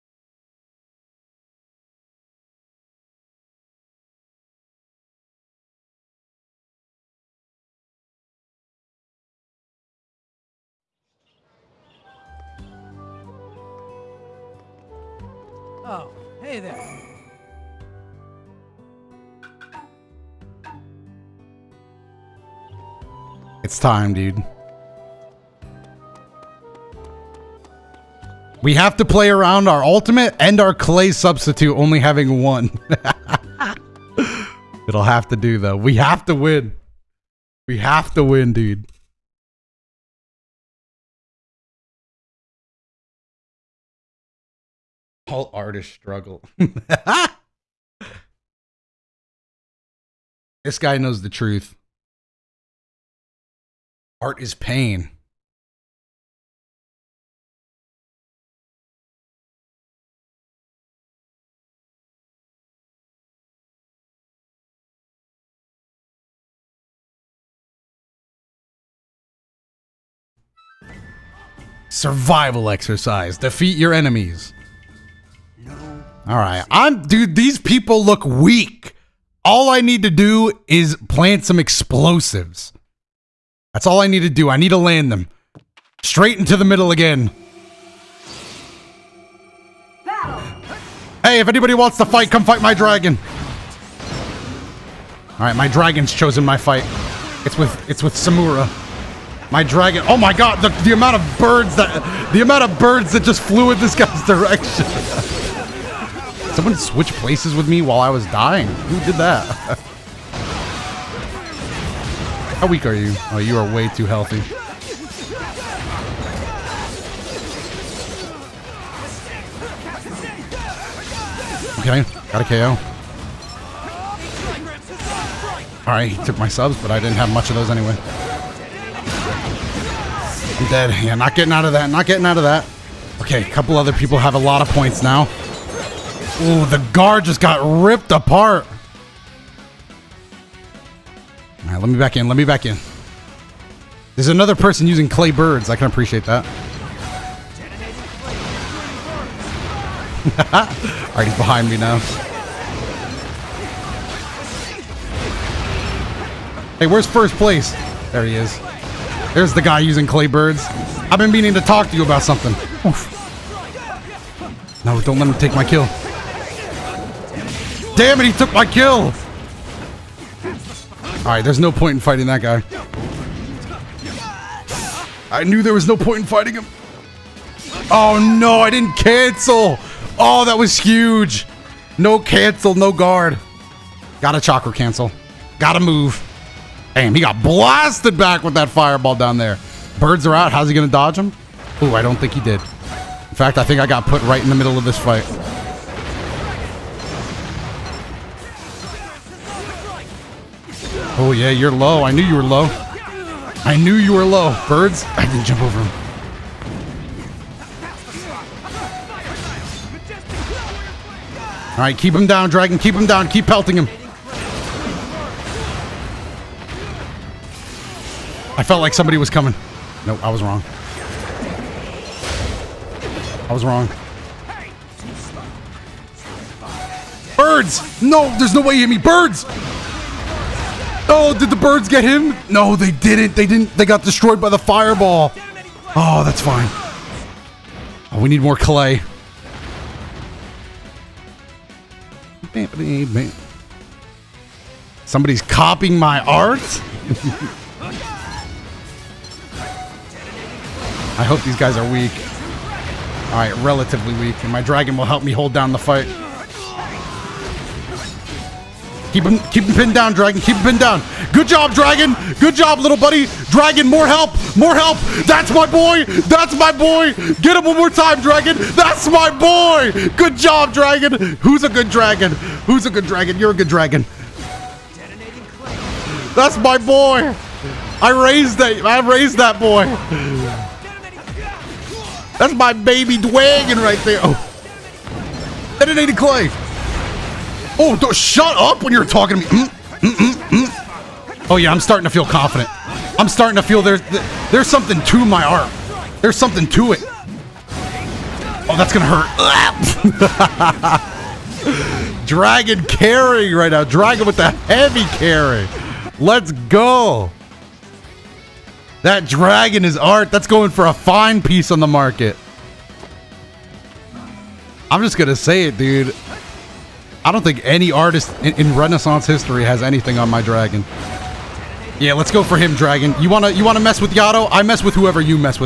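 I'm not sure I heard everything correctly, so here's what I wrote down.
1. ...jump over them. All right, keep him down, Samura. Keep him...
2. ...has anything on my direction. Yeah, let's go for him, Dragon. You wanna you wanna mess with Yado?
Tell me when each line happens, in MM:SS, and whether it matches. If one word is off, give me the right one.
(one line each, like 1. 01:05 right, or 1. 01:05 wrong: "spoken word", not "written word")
1. 03:25 wrong: "Dragon", not "Samura"
2. 05:19 wrong: "dragon", not "direction".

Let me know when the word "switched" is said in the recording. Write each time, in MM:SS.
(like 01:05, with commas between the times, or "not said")
01:46.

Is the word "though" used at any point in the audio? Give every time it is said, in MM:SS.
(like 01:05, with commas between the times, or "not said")
00:35.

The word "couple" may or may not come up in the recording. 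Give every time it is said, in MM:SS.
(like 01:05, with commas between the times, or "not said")
02:13.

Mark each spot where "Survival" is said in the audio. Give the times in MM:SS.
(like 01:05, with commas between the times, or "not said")
01:11.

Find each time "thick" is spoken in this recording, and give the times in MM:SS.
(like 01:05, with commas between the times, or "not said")
not said.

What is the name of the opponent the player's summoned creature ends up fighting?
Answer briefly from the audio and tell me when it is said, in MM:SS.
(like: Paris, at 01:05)
Samura, at 01:38.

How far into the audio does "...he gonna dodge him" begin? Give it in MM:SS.
03:10.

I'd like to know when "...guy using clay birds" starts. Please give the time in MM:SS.
02:39.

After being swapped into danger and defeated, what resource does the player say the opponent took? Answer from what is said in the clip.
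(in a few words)
subs.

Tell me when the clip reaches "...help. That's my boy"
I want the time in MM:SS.
04:24.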